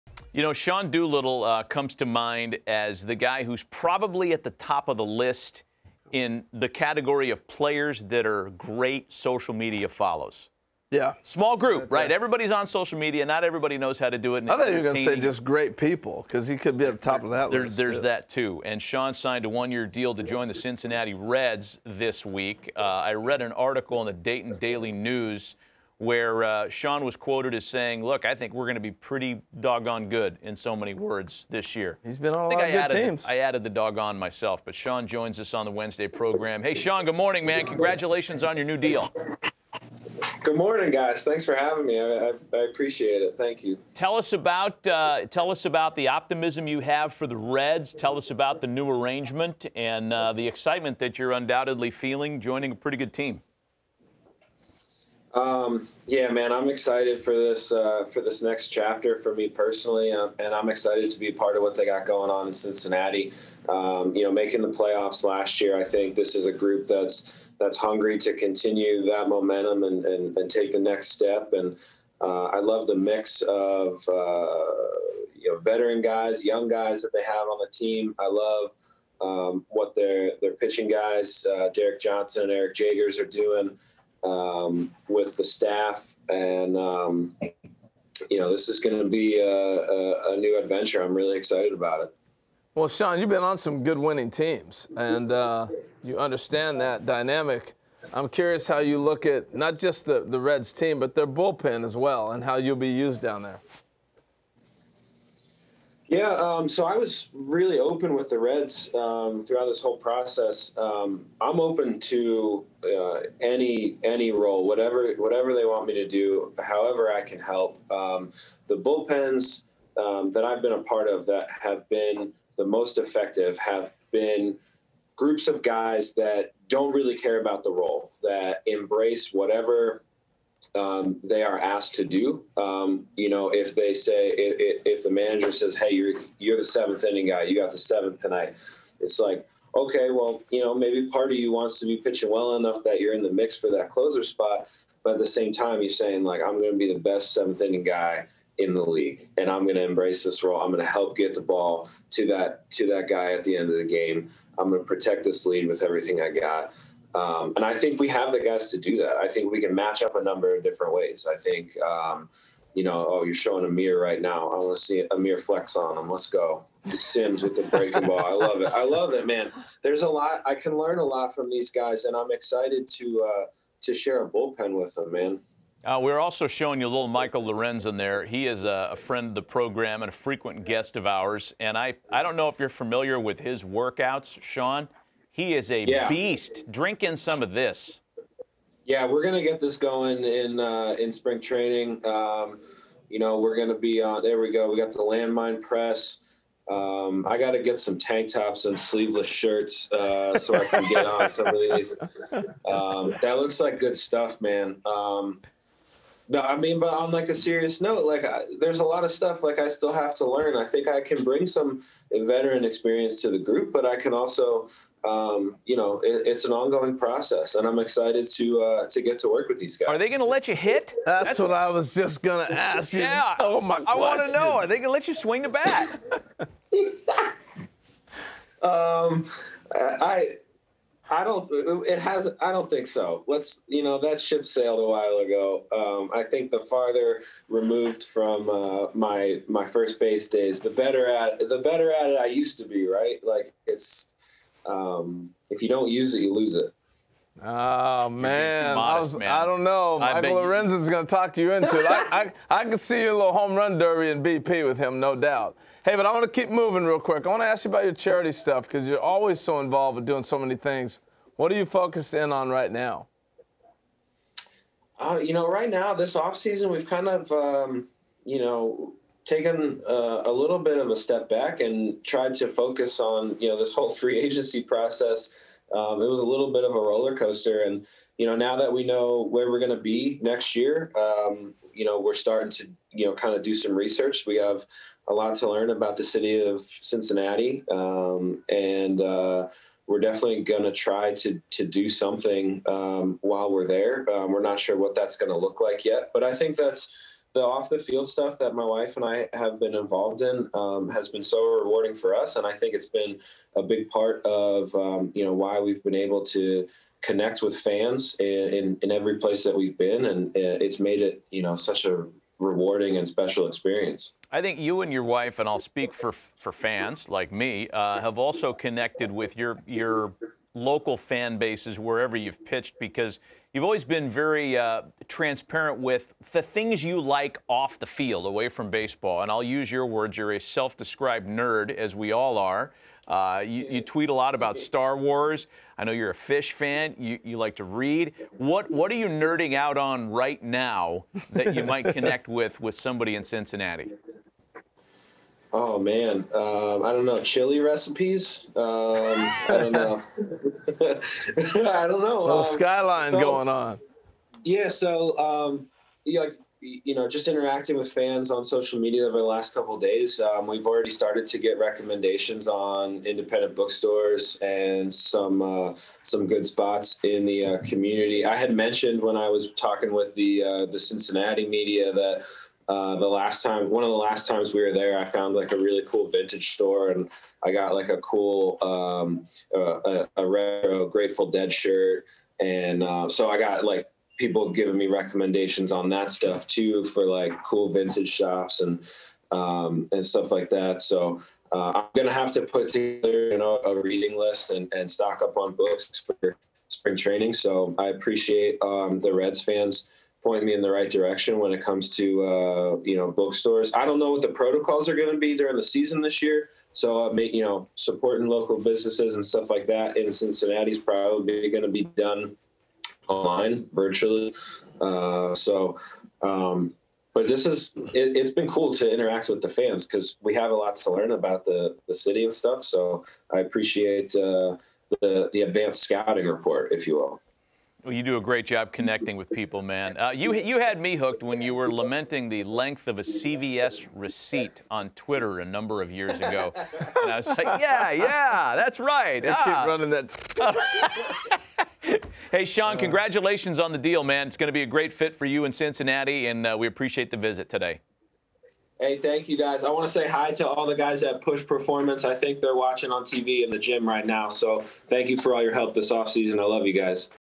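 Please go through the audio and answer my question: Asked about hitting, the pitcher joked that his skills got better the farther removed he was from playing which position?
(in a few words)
First base.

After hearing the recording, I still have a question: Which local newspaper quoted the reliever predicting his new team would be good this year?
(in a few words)
Dayton Daily News.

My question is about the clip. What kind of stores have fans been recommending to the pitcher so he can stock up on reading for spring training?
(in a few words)
Independent bookstores.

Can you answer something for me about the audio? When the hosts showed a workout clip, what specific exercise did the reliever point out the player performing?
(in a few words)
Landmine press.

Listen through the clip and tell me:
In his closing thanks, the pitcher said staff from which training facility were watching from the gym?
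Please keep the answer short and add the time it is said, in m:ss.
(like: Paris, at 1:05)
Push Performance, at 7:31.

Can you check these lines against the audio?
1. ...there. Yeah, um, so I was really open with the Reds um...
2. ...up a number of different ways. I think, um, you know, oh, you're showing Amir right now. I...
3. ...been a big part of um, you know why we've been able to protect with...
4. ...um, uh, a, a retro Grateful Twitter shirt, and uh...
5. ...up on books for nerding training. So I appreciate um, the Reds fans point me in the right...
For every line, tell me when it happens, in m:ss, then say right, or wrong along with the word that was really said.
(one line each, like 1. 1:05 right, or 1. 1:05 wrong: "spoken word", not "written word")
1. 1:43 right
2. 2:40 right
3. 5:02 wrong: "connect", not "protect"
4. 6:18 wrong: "Dead", not "Twitter"
5. 6:35 wrong: "spring", not "nerding".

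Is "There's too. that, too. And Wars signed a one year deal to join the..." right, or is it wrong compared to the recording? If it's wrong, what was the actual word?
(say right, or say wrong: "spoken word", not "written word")
wrong: "Sean", not "Wars".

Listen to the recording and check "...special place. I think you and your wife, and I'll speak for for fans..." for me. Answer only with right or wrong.
wrong.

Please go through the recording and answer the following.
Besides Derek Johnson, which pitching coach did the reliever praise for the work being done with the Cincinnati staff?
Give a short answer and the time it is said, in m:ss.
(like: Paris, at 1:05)
Eric Jagers, at 1:22.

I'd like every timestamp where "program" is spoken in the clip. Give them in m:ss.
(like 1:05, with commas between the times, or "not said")
0:36, 2:59.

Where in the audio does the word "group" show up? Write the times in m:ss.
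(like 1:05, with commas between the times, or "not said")
0:11, 1:06, 2:05, 3:33.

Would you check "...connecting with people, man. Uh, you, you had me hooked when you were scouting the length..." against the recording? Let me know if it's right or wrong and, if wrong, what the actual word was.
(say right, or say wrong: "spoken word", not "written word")
wrong: "lamenting", not "scouting".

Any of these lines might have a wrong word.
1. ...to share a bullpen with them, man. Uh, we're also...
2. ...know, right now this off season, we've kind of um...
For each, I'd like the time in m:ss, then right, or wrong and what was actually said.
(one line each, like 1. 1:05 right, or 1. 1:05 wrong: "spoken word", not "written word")
1. 2:53 right
2. 4:25 right.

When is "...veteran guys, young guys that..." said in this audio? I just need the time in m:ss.
1:15.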